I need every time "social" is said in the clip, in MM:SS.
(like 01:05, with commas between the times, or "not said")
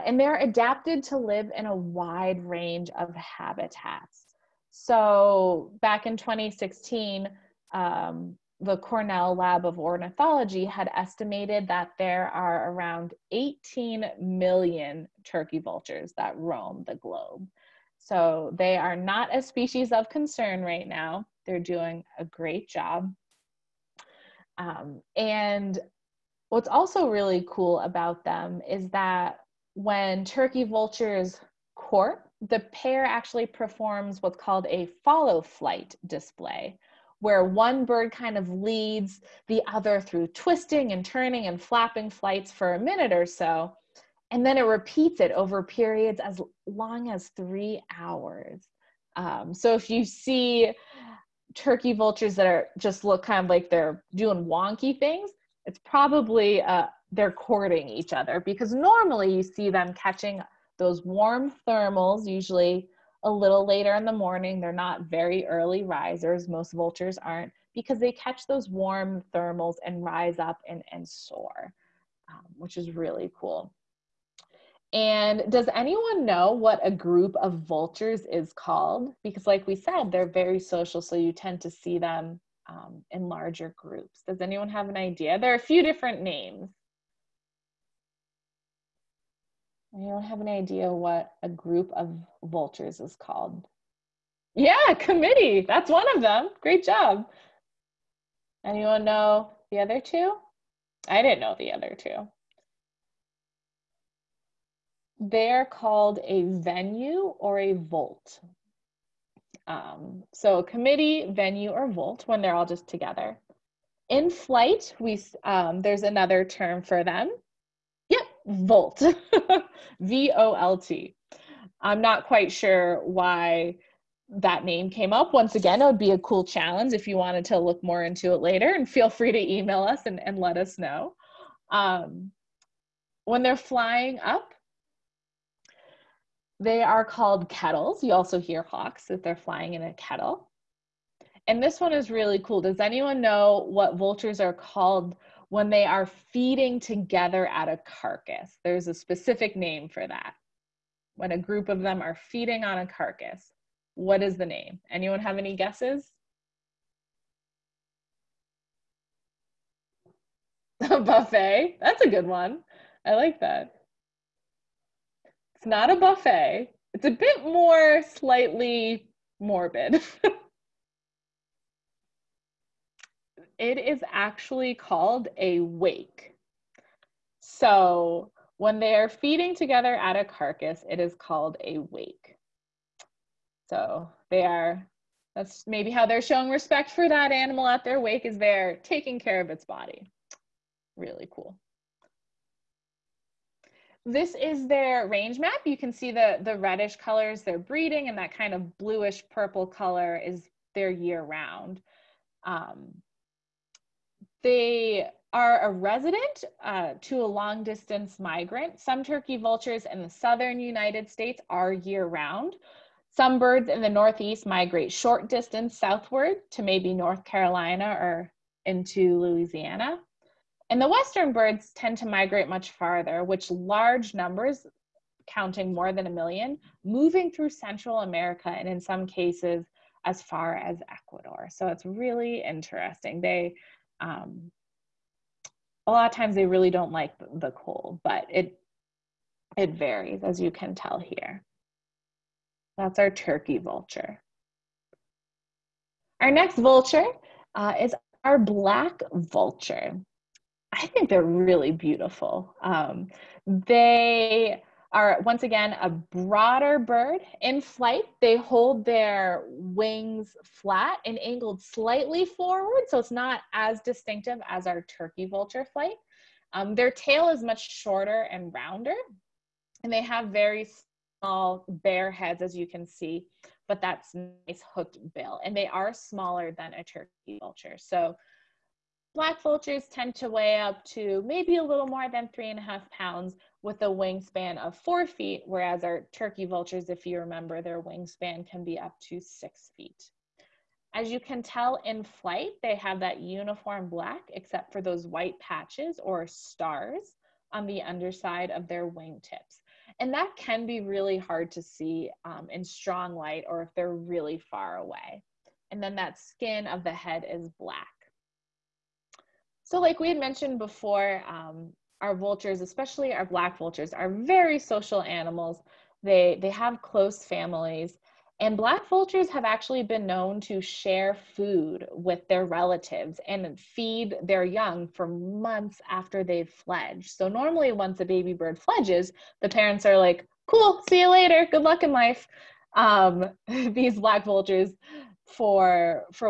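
01:20, 05:14.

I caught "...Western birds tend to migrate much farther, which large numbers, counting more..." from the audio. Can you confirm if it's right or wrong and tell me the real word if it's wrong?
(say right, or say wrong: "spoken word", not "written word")
right.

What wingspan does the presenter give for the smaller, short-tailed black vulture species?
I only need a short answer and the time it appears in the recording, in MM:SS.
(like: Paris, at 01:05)
4 feet, at 04:44.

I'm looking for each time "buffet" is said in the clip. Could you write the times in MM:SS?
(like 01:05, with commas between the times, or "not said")
02:40, 02:45.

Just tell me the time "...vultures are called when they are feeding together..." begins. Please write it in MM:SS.
02:23.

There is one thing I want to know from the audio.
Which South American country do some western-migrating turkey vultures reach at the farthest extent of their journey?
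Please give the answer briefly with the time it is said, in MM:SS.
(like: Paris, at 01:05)
Ecuador, at 03:50.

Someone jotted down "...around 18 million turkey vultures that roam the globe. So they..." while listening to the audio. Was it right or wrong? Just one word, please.
right.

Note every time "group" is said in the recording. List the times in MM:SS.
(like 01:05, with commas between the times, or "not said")
01:16, 01:23, 01:31, 02:31.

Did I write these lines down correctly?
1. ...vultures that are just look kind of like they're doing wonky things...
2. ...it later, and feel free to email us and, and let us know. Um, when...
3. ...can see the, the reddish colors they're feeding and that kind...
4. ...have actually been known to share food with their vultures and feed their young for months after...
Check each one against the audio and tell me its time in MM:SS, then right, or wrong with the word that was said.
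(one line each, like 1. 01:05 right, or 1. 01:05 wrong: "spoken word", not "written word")
1. 00:51 right
2. 02:08 right
3. 03:15 wrong: "breeding", not "feeding"
4. 05:19 wrong: "relatives", not "vultures".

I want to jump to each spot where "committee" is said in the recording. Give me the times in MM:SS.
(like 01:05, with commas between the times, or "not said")
01:34, 01:50.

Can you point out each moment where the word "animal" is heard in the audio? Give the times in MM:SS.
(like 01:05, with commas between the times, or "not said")
03:07, 05:15.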